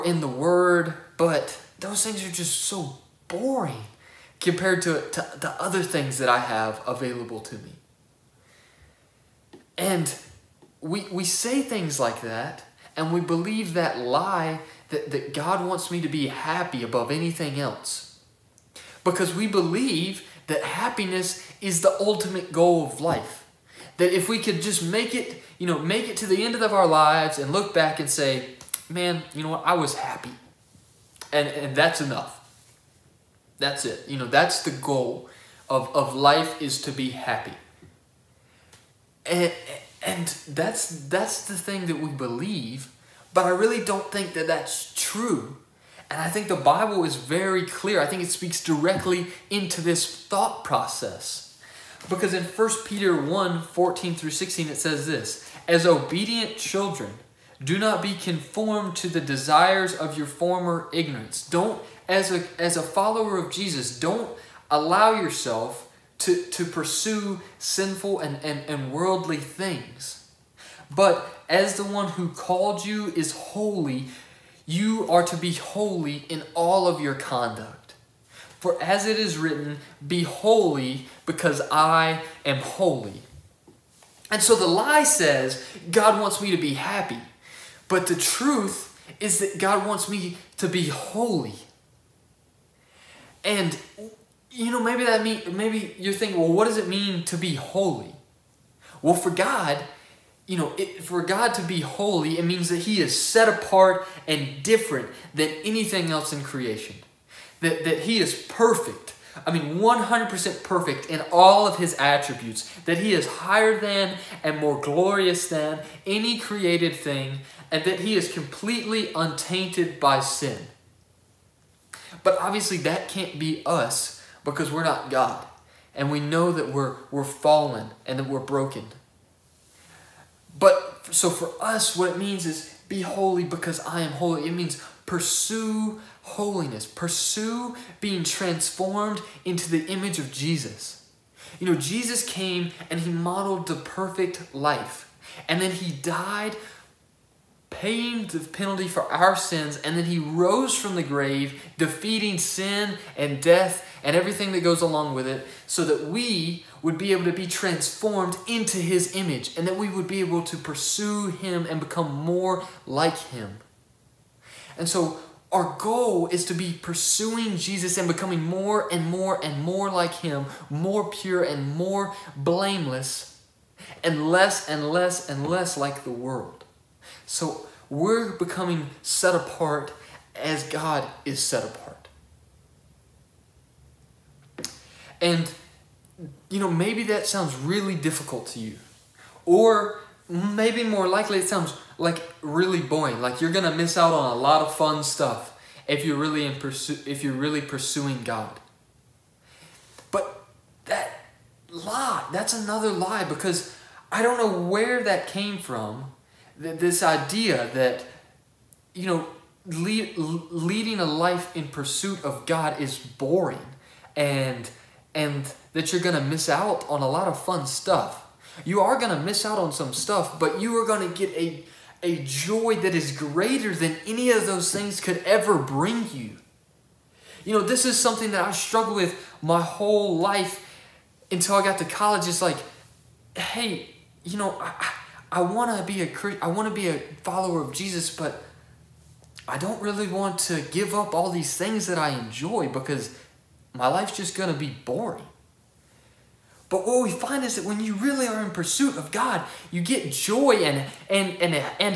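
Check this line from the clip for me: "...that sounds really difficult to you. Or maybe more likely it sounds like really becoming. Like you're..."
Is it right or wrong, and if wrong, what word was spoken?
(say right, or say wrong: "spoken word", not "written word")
wrong: "boring", not "becoming".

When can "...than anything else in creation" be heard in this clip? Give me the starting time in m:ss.
1:45.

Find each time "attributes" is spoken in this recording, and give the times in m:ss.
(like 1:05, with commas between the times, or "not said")
1:51.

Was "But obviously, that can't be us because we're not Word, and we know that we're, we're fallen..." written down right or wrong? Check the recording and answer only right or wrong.
wrong.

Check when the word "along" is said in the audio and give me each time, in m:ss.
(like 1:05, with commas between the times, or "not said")
2:34.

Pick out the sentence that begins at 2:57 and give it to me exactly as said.
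So we're becoming set apart as God is set apart.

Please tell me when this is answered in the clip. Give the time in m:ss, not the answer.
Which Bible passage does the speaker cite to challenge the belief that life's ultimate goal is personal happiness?
0:52.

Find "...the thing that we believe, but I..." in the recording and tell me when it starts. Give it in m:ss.
0:41.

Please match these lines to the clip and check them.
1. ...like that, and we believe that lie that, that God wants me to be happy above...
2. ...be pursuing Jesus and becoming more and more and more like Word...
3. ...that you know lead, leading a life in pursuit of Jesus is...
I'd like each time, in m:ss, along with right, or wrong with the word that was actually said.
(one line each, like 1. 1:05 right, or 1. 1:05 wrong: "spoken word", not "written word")
1. 0:11 right
2. 2:46 wrong: "Him", not "Word"
3. 3:27 wrong: "God", not "Jesus".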